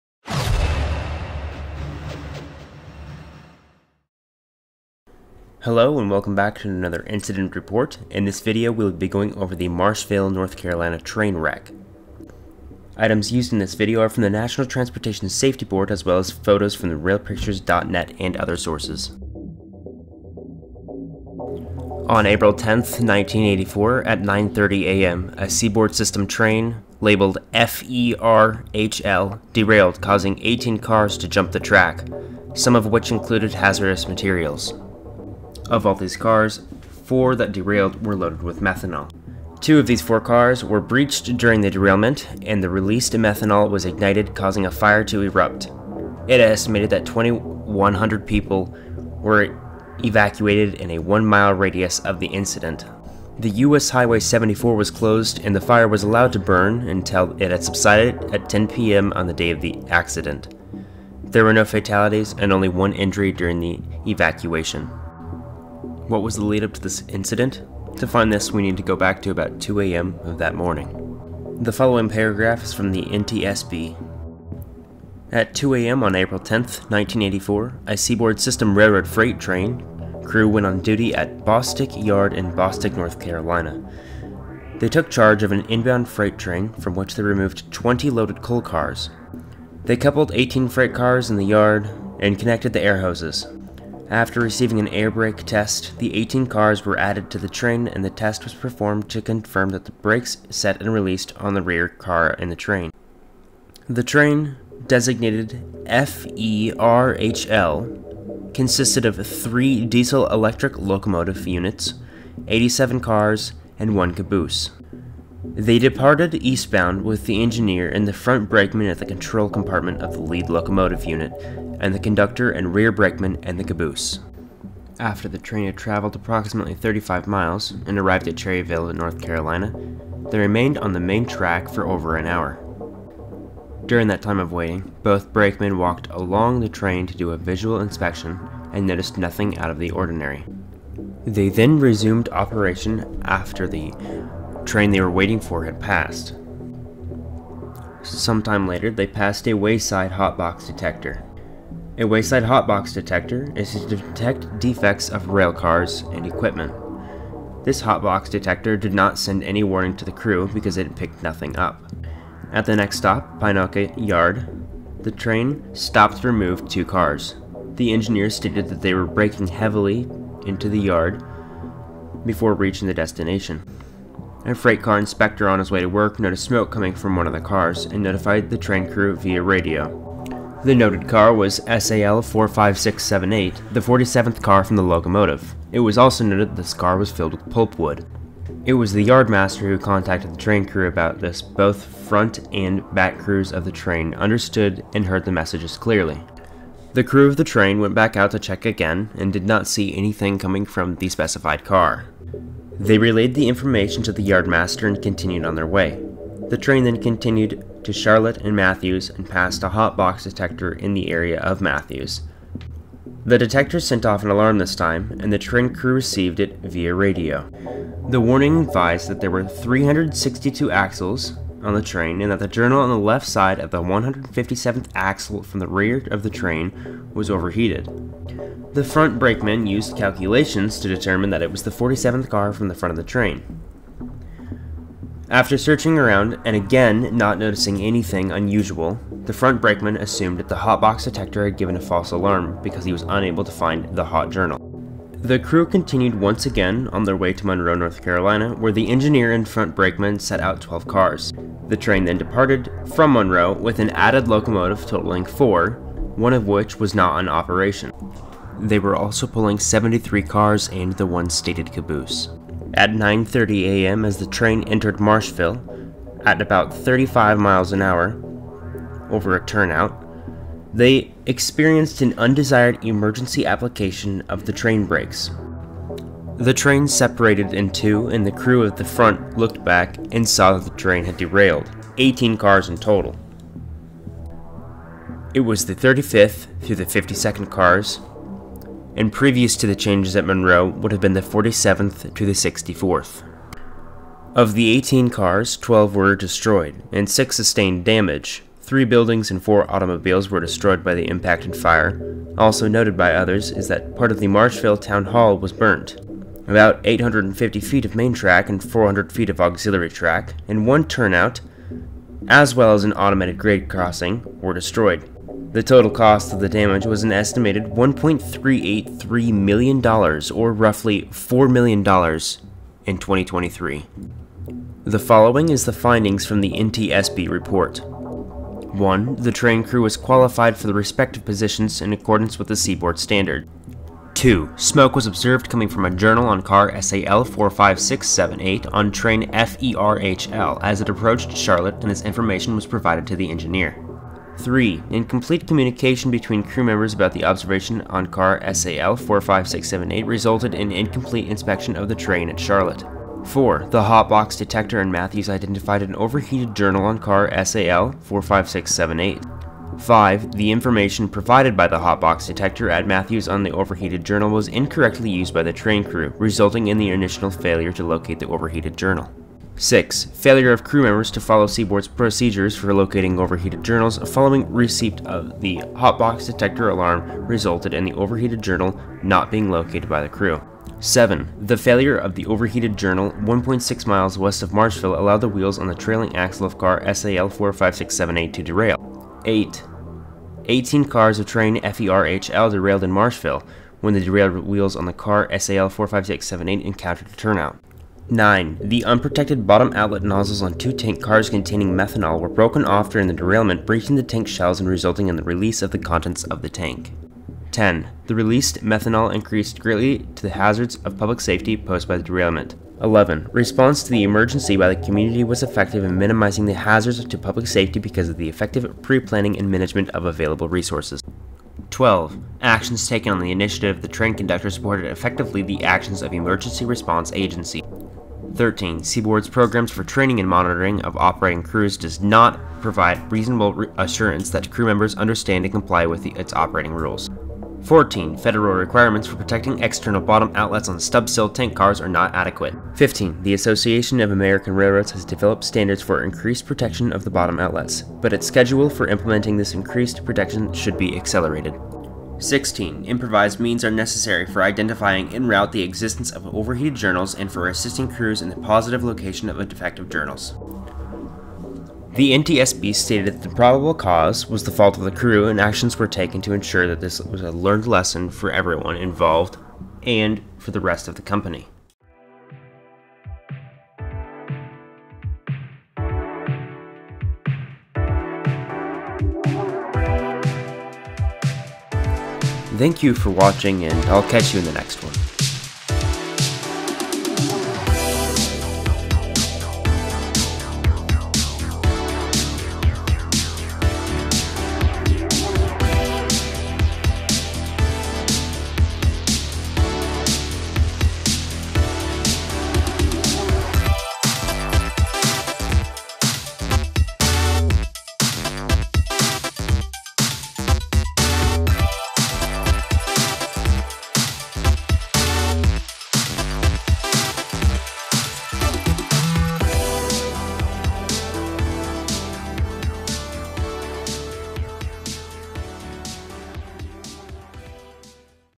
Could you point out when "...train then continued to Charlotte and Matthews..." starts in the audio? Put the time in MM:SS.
03:26.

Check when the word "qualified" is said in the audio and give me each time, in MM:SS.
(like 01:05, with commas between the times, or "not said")
05:29.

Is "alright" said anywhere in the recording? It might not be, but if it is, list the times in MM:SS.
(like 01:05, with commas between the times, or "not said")
not said.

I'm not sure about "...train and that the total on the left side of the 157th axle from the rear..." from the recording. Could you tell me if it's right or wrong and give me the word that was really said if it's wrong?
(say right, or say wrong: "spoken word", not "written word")
wrong: "journal", not "total".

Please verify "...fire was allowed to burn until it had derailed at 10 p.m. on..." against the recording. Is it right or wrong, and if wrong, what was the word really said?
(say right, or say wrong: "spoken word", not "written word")
wrong: "subsided", not "derailed".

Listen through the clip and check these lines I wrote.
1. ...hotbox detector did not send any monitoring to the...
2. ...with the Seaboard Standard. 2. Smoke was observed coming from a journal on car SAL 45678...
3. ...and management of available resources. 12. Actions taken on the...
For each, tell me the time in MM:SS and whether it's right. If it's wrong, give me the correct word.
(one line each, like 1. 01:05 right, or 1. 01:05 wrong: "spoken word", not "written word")
1. 02:37 wrong: "warning", not "monitoring"
2. 05:32 right
3. 06:59 right.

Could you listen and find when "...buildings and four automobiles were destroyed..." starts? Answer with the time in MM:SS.
04:58.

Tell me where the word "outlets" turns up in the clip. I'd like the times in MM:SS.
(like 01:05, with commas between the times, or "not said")
06:39, 07:20, 07:27.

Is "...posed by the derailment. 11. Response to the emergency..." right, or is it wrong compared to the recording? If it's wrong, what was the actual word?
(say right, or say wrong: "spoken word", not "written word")
right.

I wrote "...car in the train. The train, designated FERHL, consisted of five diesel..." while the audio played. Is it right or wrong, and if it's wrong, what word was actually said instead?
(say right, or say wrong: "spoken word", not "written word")
wrong: "three", not "five".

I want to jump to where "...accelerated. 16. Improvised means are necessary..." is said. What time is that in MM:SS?
07:30.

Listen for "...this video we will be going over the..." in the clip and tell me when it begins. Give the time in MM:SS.
00:08.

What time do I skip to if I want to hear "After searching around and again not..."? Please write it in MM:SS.
03:55.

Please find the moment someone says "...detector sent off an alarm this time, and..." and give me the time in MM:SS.
03:33.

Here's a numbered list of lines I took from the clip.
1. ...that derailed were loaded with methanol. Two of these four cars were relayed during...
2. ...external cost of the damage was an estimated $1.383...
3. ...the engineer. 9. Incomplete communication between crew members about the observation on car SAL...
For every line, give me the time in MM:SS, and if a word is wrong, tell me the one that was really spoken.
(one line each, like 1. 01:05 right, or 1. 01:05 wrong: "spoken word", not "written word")
1. 00:37 wrong: "breached", not "relayed"
2. 05:15 wrong: "total", not "external"
3. 05:43 wrong: "3", not "9".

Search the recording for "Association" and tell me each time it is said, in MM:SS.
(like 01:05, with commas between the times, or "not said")
07:23.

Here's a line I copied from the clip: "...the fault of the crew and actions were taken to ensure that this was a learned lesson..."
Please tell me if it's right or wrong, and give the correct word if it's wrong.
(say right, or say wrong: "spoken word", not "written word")
right.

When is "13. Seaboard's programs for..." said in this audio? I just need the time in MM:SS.
07:08.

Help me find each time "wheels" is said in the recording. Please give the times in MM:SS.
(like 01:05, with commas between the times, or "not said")
06:25, 06:34.